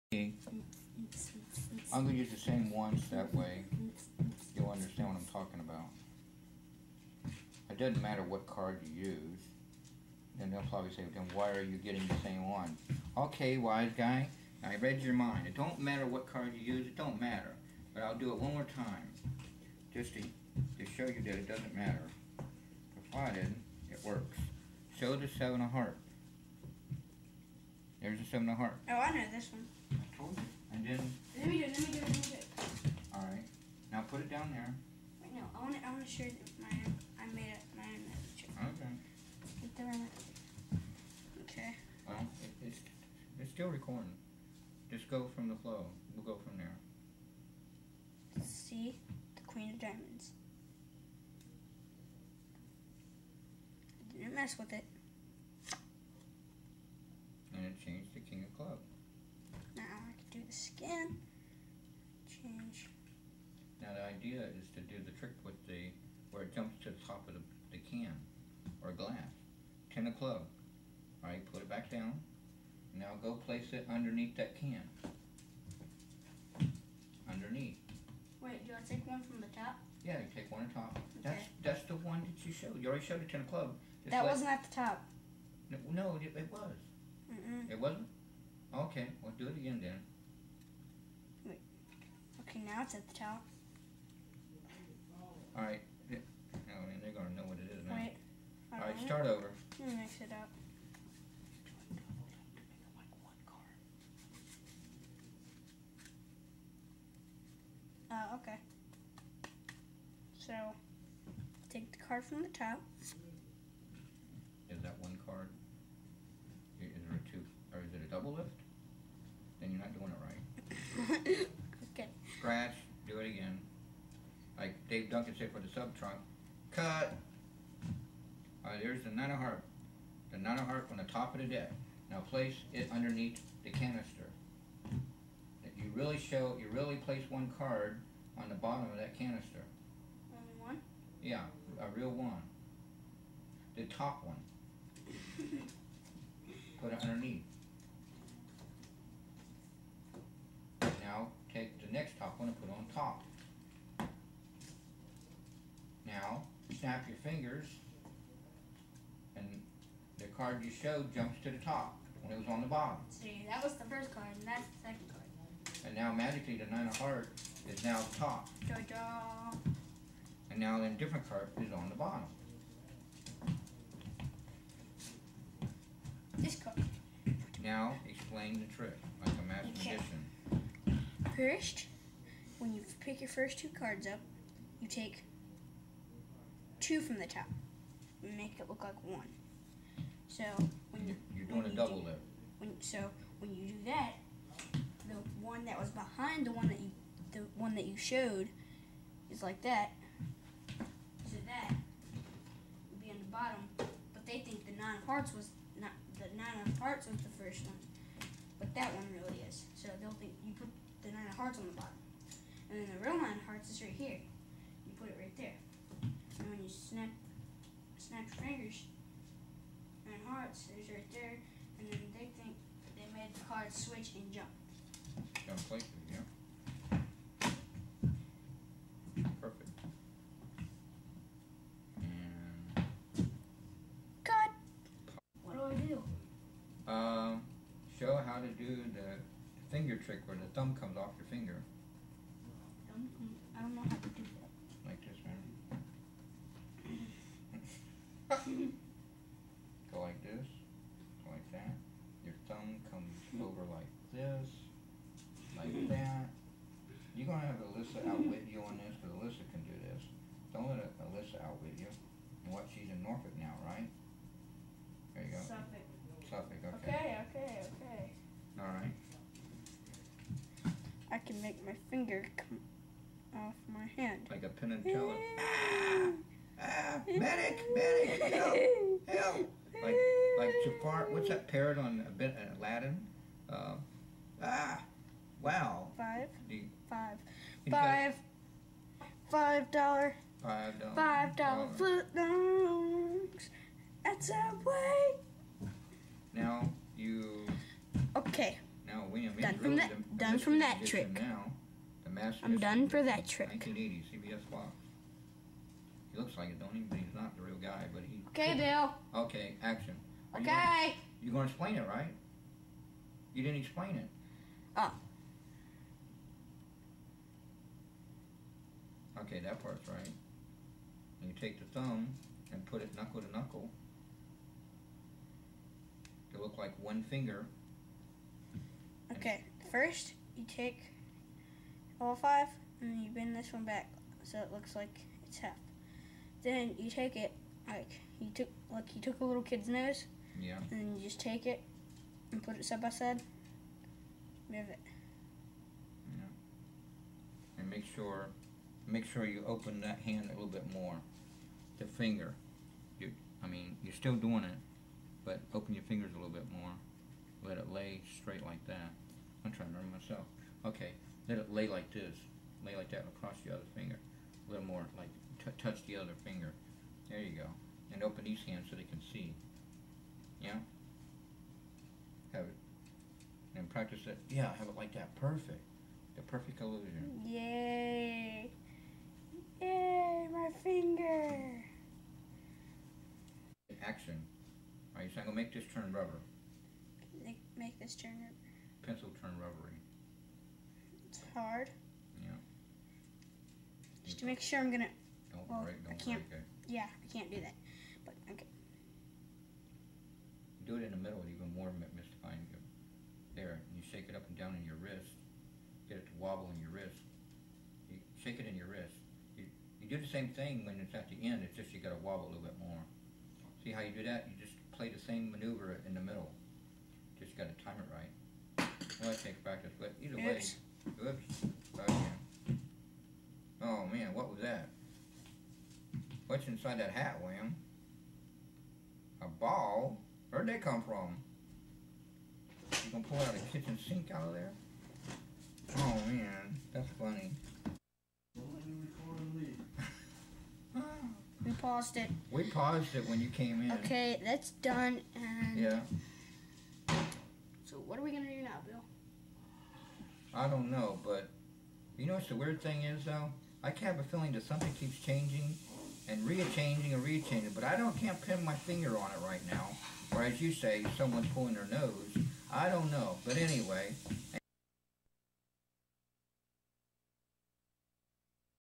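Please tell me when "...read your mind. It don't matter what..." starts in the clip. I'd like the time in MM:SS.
00:14.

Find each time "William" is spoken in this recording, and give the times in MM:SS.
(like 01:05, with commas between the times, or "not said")
04:59, 07:07.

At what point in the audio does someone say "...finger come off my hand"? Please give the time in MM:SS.
04:31.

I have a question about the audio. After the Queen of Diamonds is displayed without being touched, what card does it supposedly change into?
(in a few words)
King of Clubs.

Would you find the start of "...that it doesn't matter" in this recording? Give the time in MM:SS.
00:21.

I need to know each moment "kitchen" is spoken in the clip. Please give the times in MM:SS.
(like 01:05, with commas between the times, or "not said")
07:13.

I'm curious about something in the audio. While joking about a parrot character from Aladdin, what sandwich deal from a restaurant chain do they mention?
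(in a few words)
Five dollar footlongs.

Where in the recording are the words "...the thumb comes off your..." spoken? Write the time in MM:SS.
04:00.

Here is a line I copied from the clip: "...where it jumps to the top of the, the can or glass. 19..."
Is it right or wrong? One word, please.
wrong.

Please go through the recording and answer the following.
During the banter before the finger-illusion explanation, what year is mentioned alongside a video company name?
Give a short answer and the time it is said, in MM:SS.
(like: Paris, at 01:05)
1980, at 05:03.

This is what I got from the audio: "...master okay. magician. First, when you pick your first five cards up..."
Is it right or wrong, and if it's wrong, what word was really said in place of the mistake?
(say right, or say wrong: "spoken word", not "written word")
wrong: "two", not "five".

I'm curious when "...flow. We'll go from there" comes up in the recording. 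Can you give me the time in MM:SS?
00:45.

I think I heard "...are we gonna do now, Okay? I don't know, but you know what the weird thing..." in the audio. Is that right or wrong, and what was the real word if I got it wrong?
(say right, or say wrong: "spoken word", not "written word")
wrong: "Bill", not "Okay".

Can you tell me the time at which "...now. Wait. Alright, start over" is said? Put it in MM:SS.
01:37.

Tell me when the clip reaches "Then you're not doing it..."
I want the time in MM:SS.
01:59.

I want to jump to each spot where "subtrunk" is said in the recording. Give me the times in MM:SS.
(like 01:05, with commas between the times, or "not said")
02:05.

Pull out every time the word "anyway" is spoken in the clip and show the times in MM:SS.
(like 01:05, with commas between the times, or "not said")
07:43.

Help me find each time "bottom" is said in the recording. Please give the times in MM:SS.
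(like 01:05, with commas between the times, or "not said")
02:18, 02:42, 02:51, 03:23, 03:31.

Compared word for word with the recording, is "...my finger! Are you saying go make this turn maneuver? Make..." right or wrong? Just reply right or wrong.
wrong.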